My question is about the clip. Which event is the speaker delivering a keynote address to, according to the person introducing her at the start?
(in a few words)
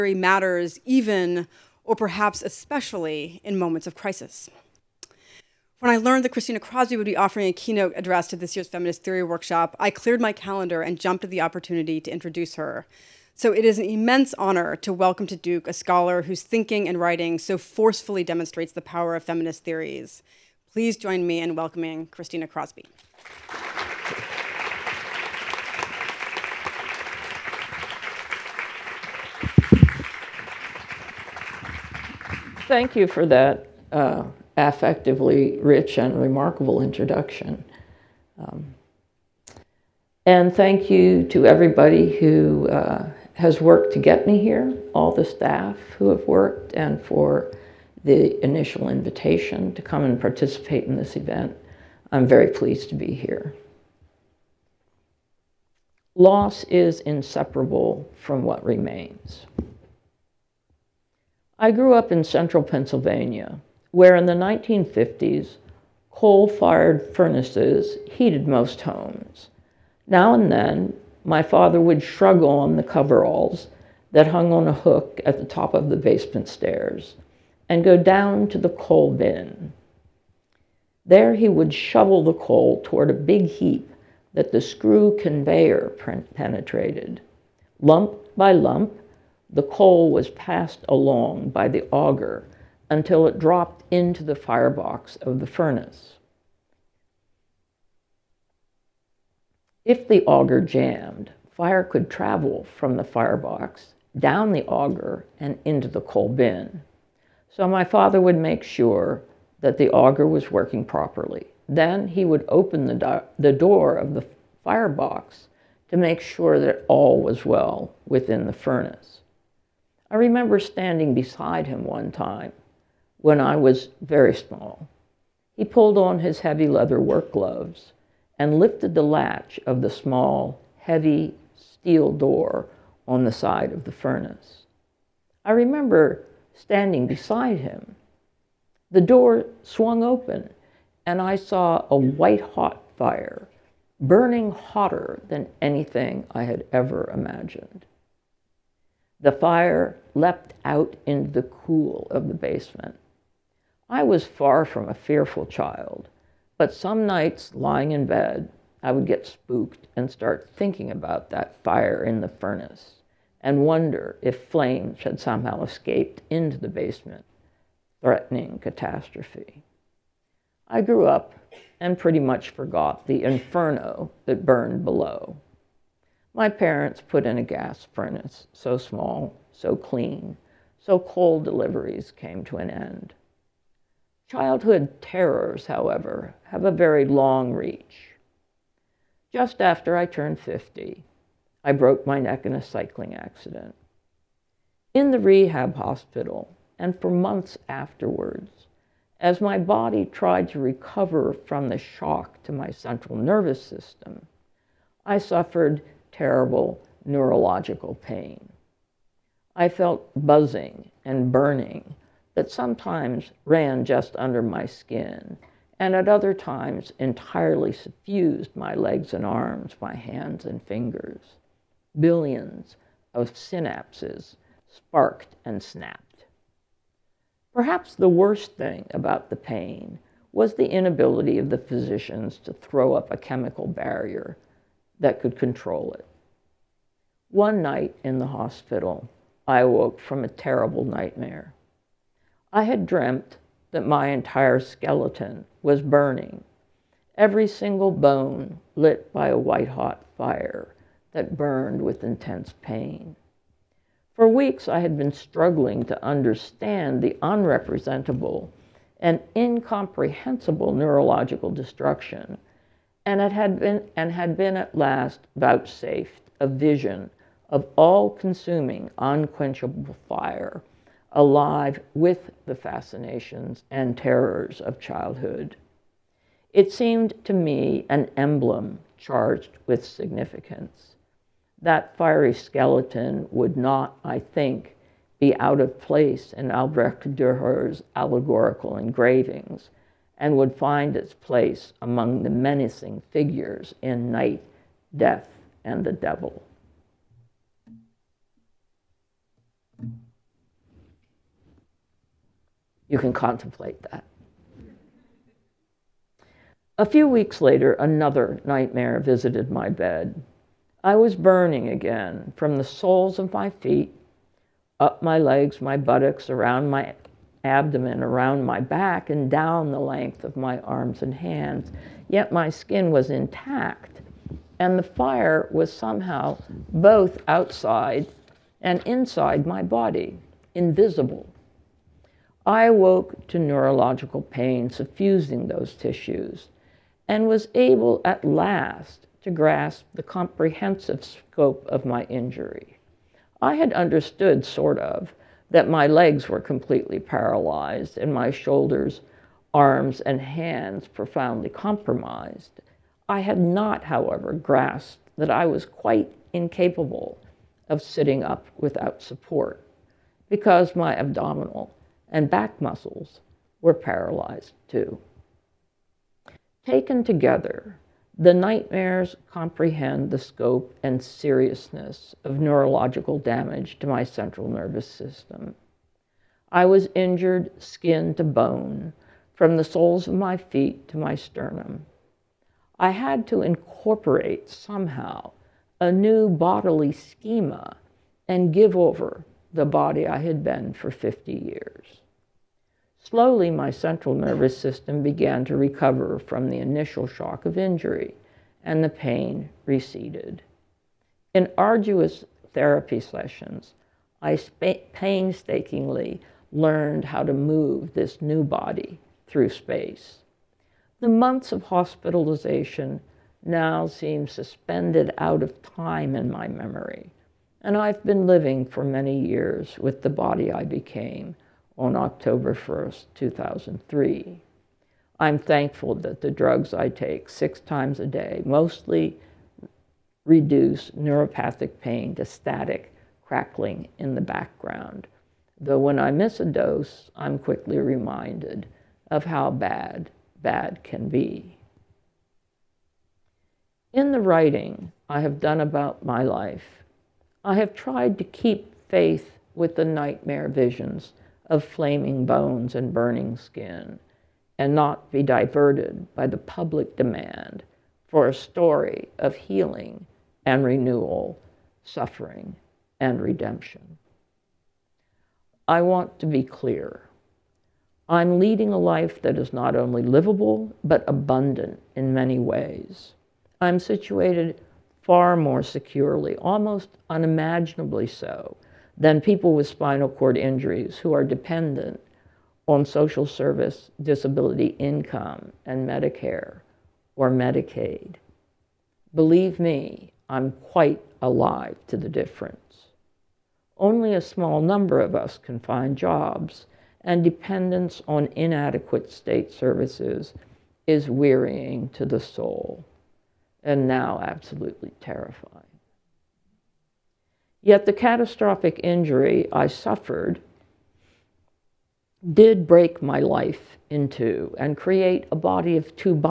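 Feminist Theory Workshop.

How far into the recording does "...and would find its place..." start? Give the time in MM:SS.
04:50.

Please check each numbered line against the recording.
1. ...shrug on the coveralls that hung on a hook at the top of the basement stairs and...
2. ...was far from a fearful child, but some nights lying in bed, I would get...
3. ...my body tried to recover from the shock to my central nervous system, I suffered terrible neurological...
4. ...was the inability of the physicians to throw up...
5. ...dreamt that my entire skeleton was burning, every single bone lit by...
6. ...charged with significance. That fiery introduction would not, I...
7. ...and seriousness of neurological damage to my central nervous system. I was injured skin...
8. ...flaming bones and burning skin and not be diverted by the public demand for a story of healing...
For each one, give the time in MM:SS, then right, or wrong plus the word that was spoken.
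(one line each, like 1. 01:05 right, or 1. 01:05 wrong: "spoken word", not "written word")
1. 01:12 right
2. 02:34 right
3. 03:19 right
4. 03:50 right
5. 04:02 right
6. 04:38 wrong: "skeleton", not "introduction"
7. 06:10 right
8. 07:31 right.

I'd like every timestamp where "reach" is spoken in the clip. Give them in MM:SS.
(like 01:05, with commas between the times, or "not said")
03:07.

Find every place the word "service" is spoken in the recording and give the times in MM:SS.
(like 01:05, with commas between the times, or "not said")
08:03, 08:19.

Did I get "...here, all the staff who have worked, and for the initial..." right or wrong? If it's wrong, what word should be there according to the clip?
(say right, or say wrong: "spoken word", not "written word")
right.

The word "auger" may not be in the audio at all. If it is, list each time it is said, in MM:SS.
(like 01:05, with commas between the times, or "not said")
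01:31, 01:40, 01:44, 01:49.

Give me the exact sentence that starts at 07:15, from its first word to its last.
Though when I miss a dose, I'm quickly reminded of how bad bad can be.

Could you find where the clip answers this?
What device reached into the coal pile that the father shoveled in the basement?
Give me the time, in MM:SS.
01:24.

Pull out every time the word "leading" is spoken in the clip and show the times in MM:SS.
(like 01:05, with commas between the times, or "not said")
07:48.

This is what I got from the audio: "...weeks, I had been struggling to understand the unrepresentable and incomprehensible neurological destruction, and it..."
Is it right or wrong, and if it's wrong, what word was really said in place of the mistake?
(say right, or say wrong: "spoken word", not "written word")
right.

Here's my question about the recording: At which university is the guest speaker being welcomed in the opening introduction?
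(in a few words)
Duke.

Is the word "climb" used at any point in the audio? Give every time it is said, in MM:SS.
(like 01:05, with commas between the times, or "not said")
not said.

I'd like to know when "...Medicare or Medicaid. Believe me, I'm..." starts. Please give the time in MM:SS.
08:05.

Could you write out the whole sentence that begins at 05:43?
I had understood, sort of, that my legs were completely paralyzed and my shoulders, arms, and hands profoundly compromised.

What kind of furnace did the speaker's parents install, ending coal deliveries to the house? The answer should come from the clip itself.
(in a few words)
Gas furnace.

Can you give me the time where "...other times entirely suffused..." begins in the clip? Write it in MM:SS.
03:36.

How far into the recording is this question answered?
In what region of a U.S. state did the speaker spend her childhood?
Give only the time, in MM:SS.
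01:02.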